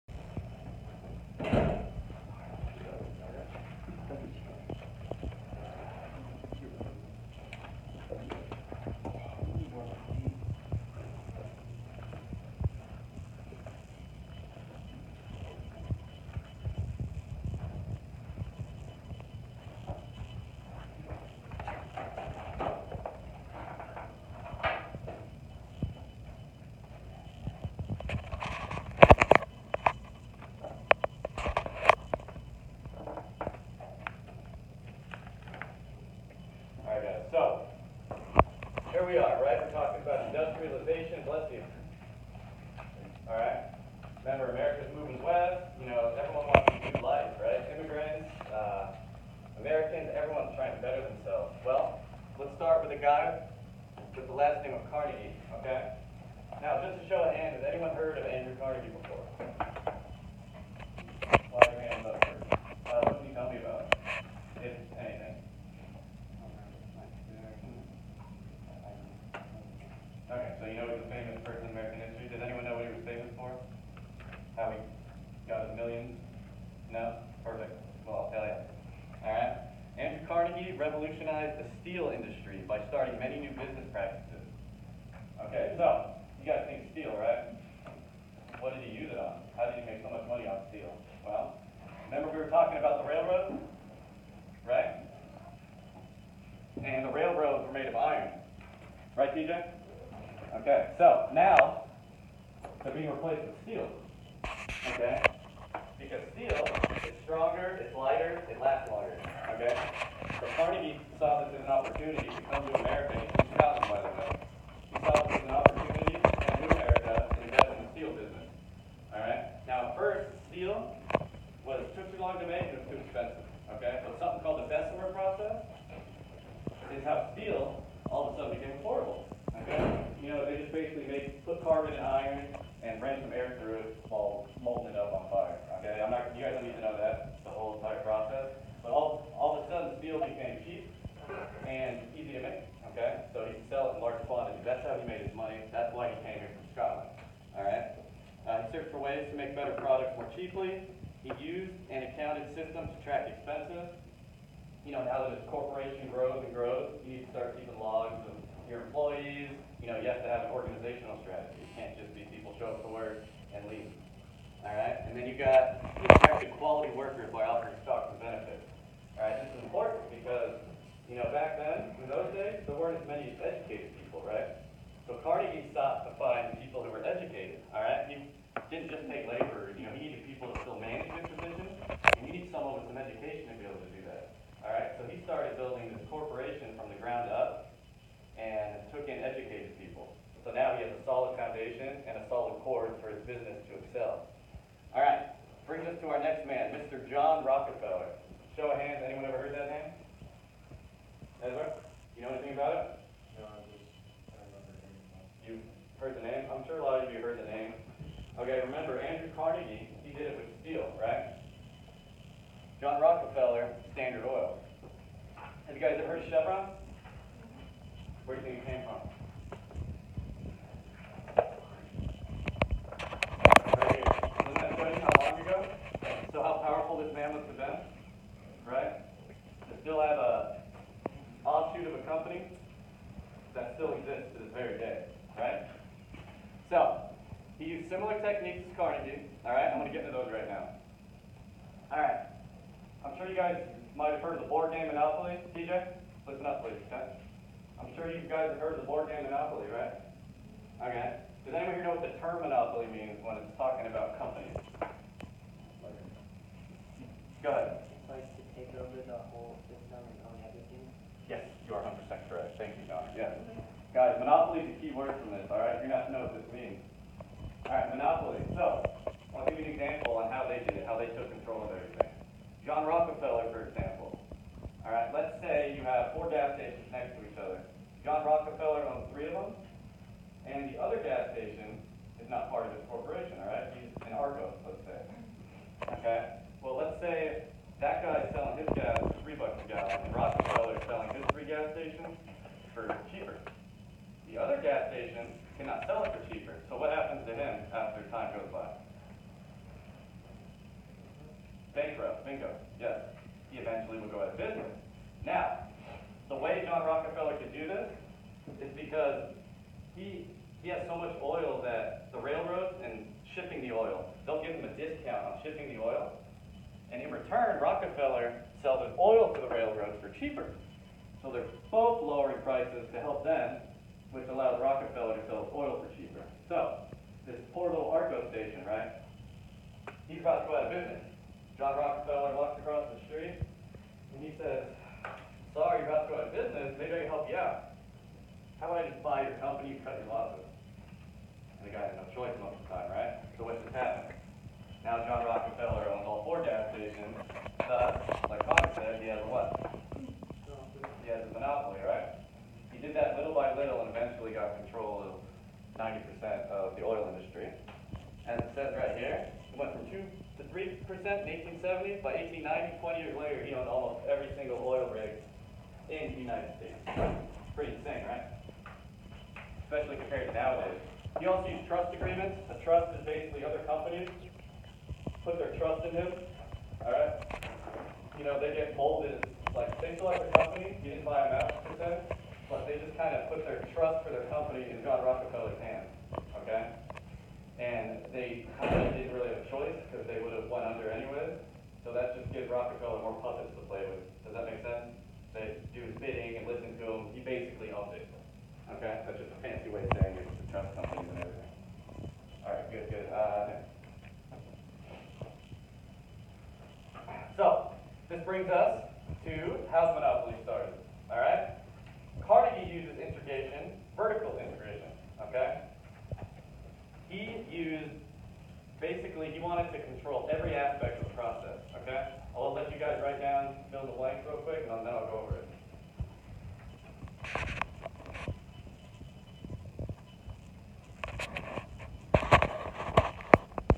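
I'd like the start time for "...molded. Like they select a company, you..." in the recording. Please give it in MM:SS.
06:18.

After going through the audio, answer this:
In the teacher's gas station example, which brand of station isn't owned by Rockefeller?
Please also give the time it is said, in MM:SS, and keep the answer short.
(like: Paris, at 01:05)
ARCO, at 04:44.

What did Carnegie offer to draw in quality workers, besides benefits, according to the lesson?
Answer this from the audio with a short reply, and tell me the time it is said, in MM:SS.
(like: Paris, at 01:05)
stocks, at 02:47.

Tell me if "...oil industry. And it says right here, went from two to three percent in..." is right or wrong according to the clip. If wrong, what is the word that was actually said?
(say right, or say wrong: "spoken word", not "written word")
right.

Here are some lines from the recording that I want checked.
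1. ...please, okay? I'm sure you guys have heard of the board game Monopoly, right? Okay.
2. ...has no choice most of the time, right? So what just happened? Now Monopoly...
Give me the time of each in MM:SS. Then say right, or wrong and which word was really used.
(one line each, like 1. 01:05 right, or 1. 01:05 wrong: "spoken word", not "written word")
1. 04:06 right
2. 05:41 wrong: "John", not "Monopoly".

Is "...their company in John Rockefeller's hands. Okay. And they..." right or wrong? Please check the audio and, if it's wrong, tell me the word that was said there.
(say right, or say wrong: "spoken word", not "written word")
right.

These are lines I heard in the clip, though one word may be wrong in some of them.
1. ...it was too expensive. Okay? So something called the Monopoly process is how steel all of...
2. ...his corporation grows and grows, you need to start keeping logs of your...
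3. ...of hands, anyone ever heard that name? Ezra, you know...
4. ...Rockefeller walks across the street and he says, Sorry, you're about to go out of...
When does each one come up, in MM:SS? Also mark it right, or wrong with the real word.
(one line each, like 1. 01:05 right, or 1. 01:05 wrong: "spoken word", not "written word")
1. 02:02 wrong: "Bessemer", not "Monopoly"
2. 02:35 right
3. 03:18 right
4. 05:31 right.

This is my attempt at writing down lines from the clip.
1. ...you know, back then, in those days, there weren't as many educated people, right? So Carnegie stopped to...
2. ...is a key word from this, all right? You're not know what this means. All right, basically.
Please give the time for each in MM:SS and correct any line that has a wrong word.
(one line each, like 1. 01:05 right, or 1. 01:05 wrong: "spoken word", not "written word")
1. 02:51 right
2. 04:24 wrong: "monopoly", not "basically".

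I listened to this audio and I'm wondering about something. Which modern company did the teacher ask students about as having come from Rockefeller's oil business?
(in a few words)
Chevron.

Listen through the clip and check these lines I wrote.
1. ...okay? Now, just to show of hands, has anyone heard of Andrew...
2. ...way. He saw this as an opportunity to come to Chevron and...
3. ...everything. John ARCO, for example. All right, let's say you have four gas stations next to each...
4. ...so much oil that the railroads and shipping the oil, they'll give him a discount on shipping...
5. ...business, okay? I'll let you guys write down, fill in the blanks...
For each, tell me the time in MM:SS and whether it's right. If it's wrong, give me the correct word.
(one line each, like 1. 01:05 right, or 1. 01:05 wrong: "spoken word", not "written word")
1. 00:55 right
2. 01:53 wrong: "America", not "Chevron"
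3. 04:31 wrong: "Rockefeller", not "ARCO"
4. 05:10 right
5. 07:01 wrong: "process", not "business".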